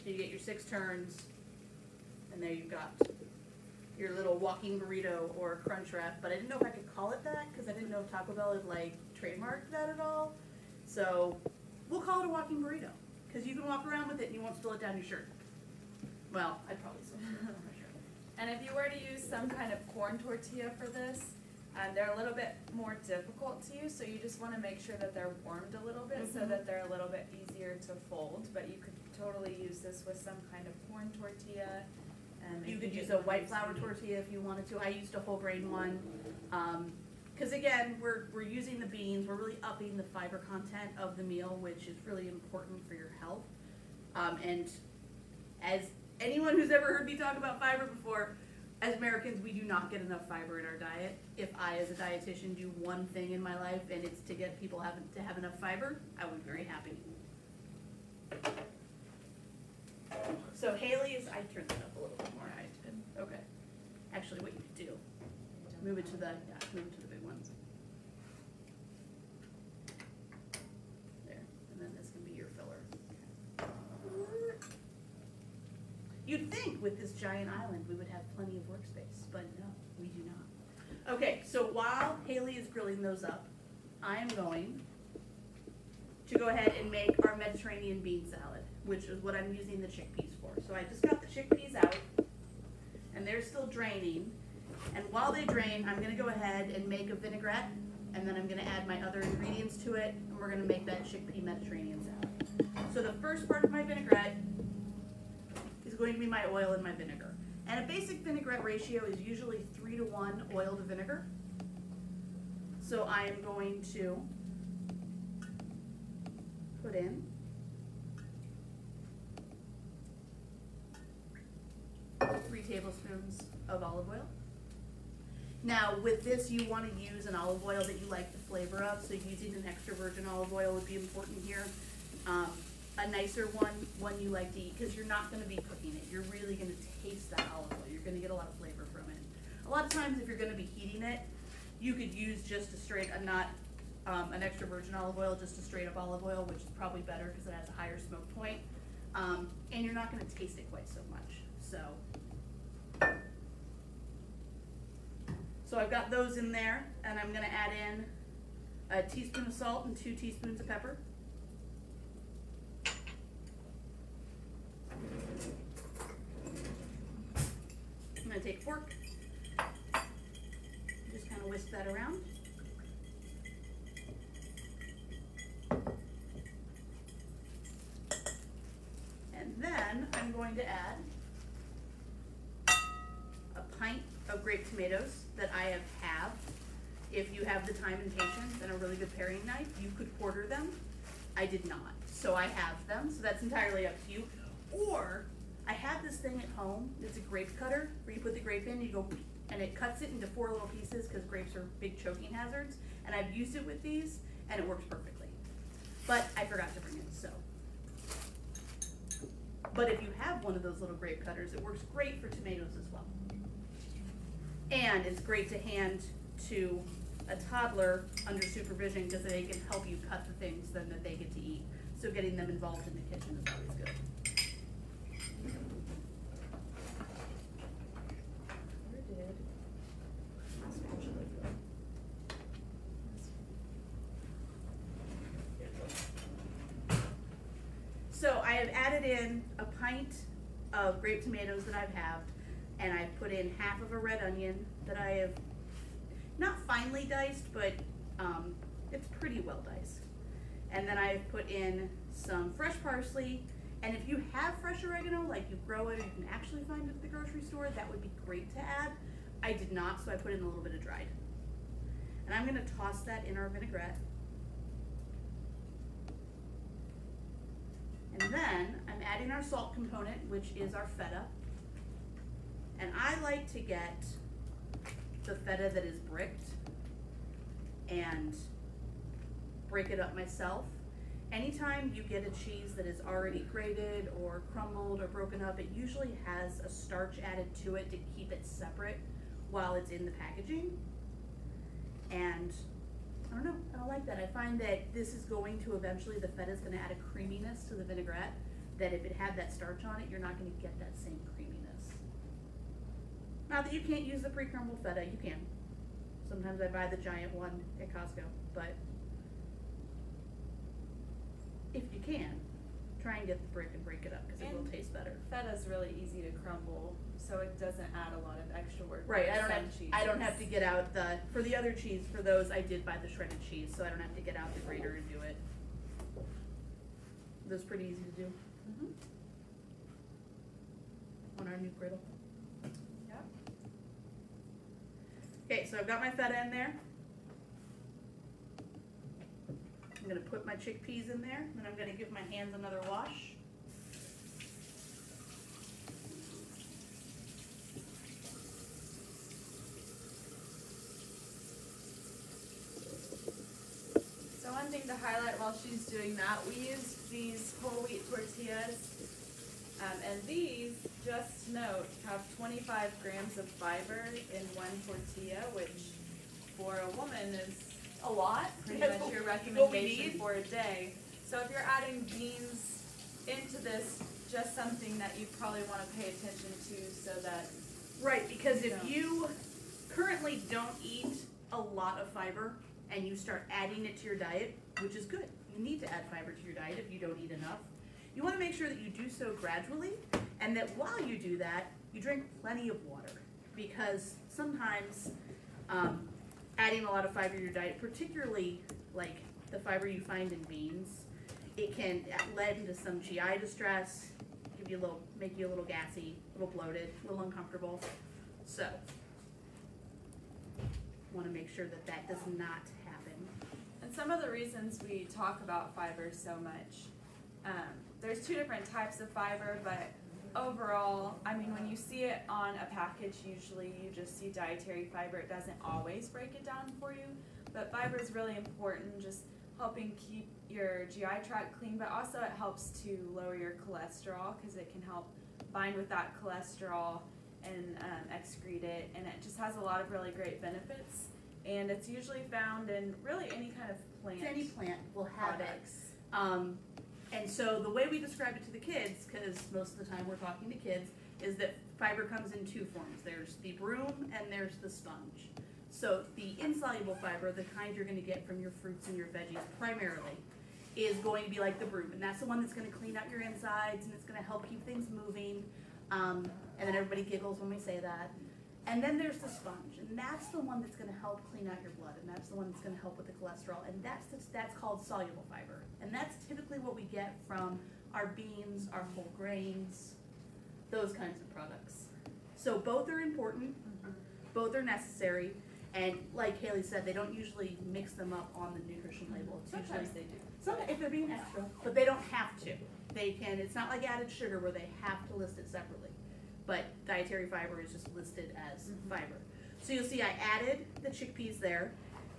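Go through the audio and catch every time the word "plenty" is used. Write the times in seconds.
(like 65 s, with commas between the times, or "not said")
78 s, 392 s.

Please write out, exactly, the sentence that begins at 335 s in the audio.
Okay, so I've got my feta in there.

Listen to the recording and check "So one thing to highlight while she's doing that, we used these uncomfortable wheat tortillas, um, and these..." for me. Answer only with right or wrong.
wrong.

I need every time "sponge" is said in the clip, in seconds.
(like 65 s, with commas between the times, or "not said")
454 s, 469 s.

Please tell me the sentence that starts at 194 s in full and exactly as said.
Or I have this thing at home.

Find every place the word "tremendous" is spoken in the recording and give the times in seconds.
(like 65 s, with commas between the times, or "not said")
not said.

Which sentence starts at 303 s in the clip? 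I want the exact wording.
Not that you can't use the pre-crumbled feta, you can.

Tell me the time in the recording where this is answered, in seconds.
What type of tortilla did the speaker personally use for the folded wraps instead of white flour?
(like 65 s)
35 s.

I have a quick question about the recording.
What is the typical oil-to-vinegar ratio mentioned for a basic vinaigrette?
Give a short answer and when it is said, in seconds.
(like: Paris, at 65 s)
3 to 1, at 109 s.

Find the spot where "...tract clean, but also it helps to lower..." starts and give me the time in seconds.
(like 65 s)
431 s.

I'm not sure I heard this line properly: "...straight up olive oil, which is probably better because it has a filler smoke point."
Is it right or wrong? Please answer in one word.
wrong.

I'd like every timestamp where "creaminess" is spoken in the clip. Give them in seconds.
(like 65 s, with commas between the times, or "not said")
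297 s, 301 s.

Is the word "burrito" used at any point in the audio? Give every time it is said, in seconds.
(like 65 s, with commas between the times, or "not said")
4 s, 12 s.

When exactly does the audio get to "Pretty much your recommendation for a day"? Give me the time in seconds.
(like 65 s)
368 s.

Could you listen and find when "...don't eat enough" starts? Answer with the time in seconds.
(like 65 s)
386 s.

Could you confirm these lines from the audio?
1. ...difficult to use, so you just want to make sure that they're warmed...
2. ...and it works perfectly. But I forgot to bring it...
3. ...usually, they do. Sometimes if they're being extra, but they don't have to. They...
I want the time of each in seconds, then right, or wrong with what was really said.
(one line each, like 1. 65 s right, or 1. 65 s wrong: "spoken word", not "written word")
1. 23 s right
2. 204 s right
3. 489 s right.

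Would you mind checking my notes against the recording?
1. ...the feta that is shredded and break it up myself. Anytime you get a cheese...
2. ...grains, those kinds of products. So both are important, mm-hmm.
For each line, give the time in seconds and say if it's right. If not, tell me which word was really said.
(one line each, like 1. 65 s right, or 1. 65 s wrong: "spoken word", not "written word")
1. 275 s wrong: "bricked", not "shredded"
2. 479 s right.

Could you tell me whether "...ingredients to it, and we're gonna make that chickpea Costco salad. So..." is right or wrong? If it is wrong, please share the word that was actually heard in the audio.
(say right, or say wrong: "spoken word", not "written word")
wrong: "Mediterranean", not "Costco".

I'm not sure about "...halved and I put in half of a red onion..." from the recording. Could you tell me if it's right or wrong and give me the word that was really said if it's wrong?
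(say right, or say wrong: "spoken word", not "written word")
right.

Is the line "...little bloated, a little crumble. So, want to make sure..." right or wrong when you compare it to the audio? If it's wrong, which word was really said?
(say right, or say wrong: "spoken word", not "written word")
wrong: "uncomfortable", not "crumble".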